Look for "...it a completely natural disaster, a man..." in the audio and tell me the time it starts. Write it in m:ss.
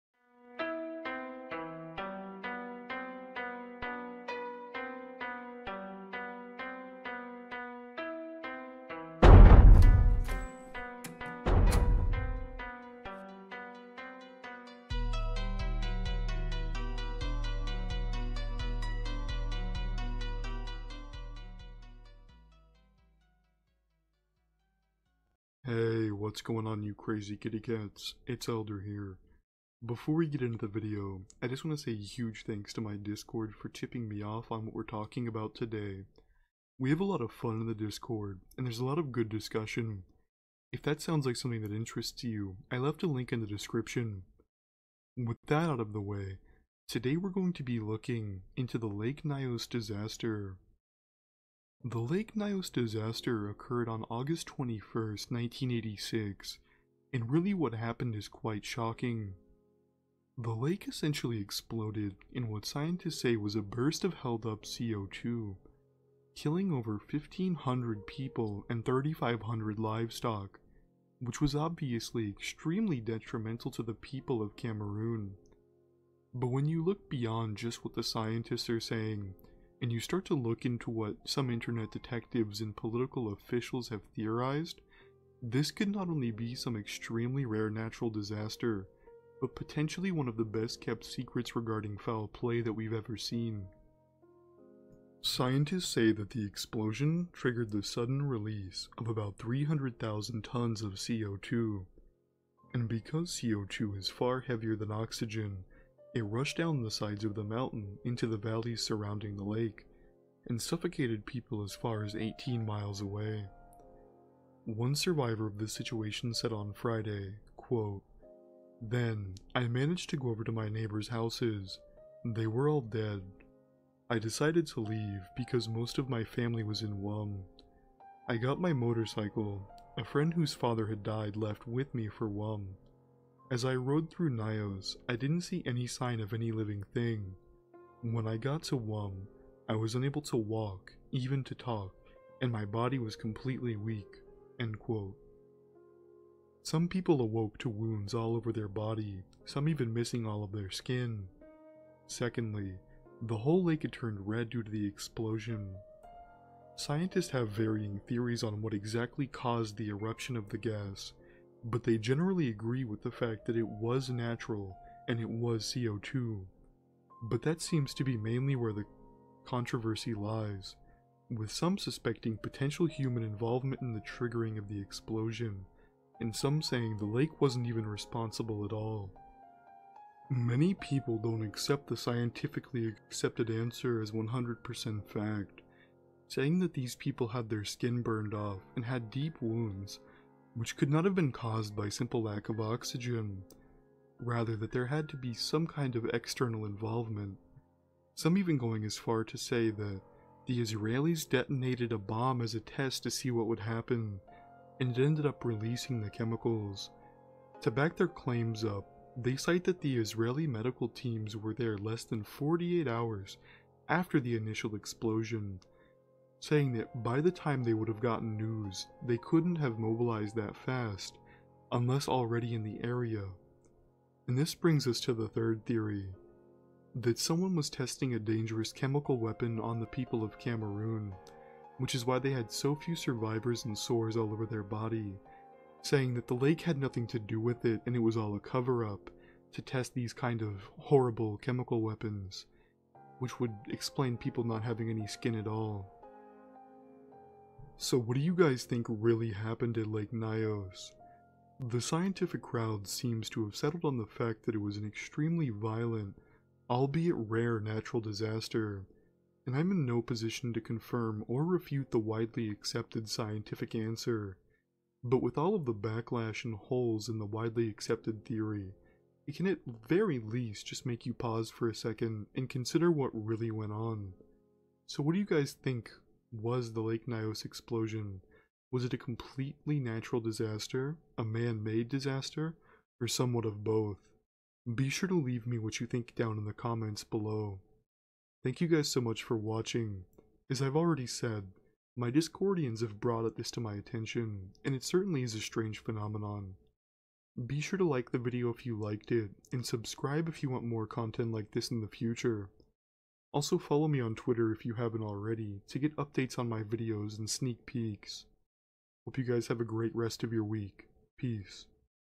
4:38.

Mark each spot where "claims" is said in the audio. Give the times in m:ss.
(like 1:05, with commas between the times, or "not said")
3:28.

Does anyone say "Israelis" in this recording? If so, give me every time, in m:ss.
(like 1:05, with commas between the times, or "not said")
3:20, 3:29.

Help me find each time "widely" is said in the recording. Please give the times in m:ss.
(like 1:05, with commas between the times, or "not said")
4:21, 4:27.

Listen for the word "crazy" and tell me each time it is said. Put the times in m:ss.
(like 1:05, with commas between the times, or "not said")
0:26.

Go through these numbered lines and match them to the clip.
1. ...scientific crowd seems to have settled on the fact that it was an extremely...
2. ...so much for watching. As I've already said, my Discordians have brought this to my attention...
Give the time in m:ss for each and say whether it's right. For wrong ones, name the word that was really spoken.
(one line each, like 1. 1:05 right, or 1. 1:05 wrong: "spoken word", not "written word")
1. 4:11 right
2. 4:48 right.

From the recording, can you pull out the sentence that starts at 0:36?
We have a lot of fun in the Discord, and there's a lot of good discussion.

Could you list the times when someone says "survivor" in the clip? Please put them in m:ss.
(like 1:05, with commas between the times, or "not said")
1:54, 3:52.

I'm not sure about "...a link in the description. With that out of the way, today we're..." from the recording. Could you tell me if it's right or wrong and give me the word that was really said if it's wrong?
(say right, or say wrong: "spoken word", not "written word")
right.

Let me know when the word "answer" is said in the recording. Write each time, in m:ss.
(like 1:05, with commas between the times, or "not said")
3:03, 4:23.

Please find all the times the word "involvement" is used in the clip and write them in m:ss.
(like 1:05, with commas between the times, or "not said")
2:53, 3:16.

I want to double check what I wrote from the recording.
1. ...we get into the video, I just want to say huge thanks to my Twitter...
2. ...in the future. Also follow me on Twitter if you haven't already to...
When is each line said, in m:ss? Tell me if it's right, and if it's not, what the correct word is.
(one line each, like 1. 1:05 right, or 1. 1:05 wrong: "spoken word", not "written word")
1. 0:30 wrong: "Discord", not "Twitter"
2. 5:01 right.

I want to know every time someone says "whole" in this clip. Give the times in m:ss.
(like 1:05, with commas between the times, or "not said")
2:33.